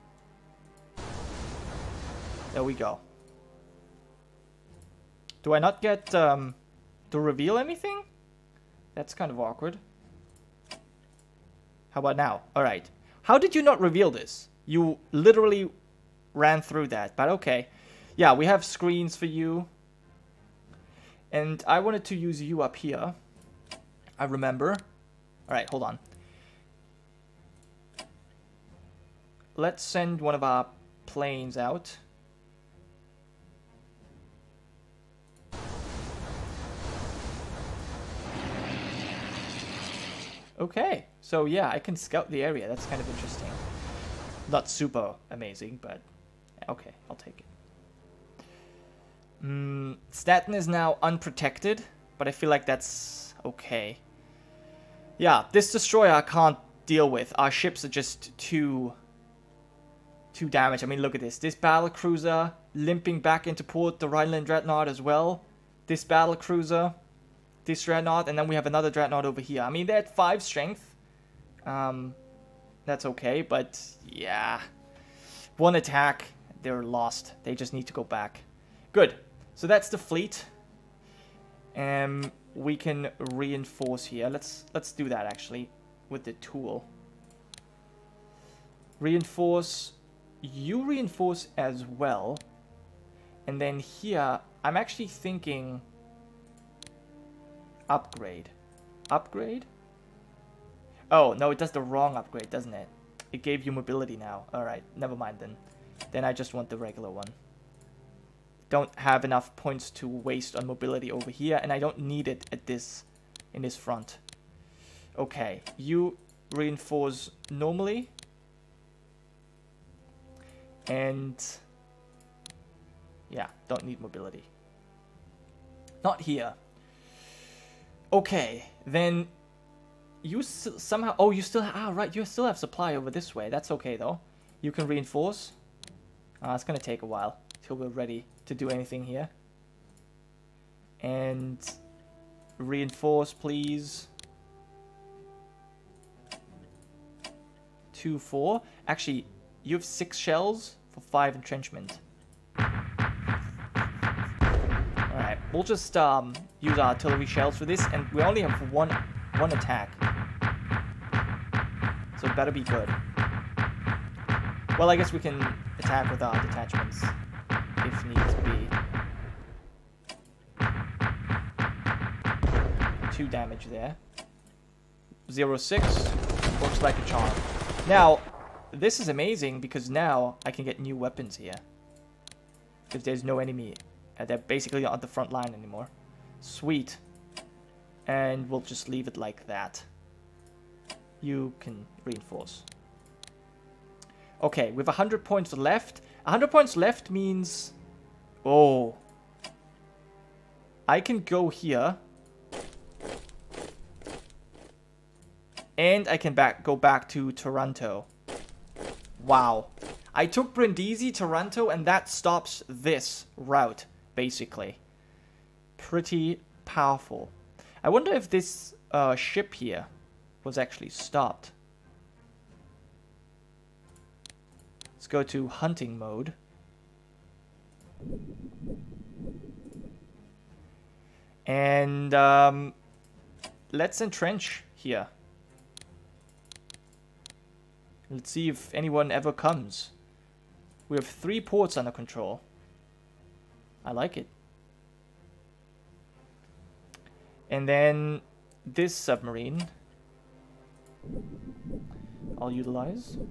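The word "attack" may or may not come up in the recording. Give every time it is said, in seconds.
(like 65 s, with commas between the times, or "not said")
75 s, 159 s, 165 s.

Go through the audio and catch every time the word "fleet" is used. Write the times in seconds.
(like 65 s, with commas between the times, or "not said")
79 s.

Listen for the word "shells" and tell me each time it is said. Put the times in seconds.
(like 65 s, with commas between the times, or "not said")
150 s, 157 s.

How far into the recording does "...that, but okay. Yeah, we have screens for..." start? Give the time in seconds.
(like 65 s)
16 s.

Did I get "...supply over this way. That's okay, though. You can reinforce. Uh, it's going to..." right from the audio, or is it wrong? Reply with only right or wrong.
right.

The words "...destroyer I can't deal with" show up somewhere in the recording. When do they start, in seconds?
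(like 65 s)
55 s.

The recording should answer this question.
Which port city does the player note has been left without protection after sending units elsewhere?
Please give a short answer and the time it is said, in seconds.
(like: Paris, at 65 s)
Stettin, at 50 s.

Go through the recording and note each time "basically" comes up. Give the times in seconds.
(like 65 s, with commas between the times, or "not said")
184 s, 214 s.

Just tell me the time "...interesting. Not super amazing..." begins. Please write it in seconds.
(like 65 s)
43 s.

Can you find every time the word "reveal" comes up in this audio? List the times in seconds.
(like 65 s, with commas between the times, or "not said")
7 s, 13 s.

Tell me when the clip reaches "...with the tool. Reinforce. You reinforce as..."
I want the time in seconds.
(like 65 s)
86 s.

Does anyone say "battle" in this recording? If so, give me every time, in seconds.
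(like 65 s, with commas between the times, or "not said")
61 s, 66 s.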